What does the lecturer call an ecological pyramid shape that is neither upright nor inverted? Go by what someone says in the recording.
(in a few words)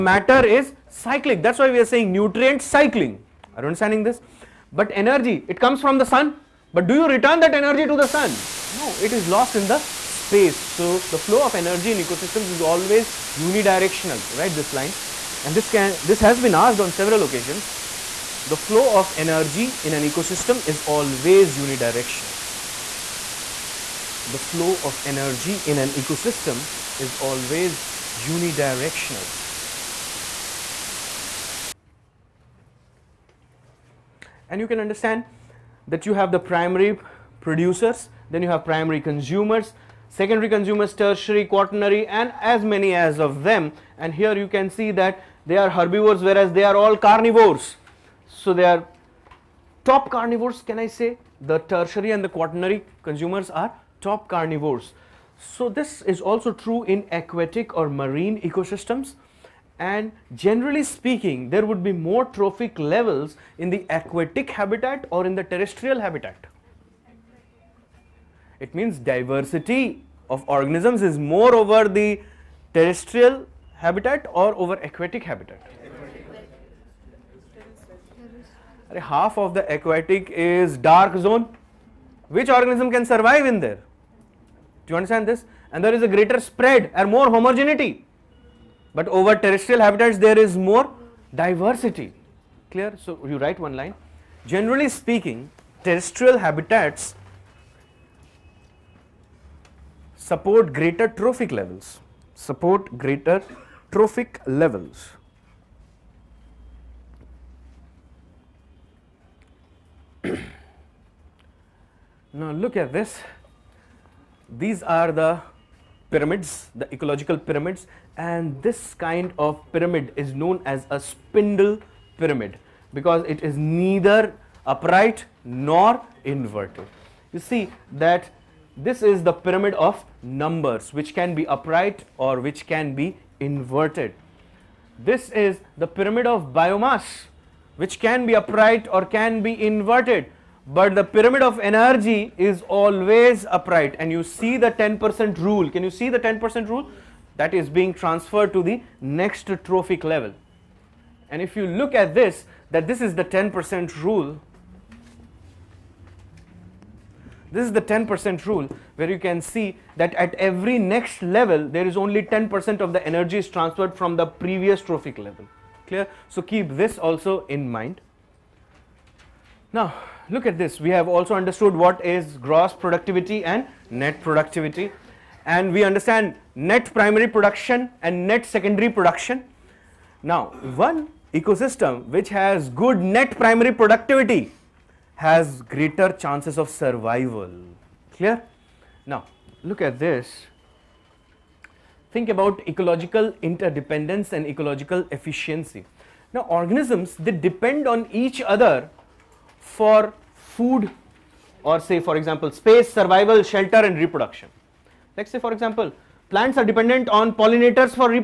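spindle pyramid.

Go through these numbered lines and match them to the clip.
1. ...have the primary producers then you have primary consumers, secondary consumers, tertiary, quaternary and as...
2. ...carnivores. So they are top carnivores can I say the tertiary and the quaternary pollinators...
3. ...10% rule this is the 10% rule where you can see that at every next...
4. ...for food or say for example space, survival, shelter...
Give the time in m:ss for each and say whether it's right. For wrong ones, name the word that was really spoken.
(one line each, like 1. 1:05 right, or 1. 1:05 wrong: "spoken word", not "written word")
1. 0:36 right
2. 0:46 wrong: "consumers", not "pollinators"
3. 2:33 right
4. 3:19 right.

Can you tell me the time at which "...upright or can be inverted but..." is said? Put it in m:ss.
2:18.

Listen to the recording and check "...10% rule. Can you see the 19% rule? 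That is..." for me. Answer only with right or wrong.
wrong.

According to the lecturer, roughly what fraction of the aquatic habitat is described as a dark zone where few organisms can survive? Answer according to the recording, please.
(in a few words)
Half.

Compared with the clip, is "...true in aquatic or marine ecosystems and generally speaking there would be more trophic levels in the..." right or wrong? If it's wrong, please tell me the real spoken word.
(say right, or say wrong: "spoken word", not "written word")
right.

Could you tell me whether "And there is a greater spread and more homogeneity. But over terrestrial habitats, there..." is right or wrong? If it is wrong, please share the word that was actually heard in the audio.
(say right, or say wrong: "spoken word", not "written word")
right.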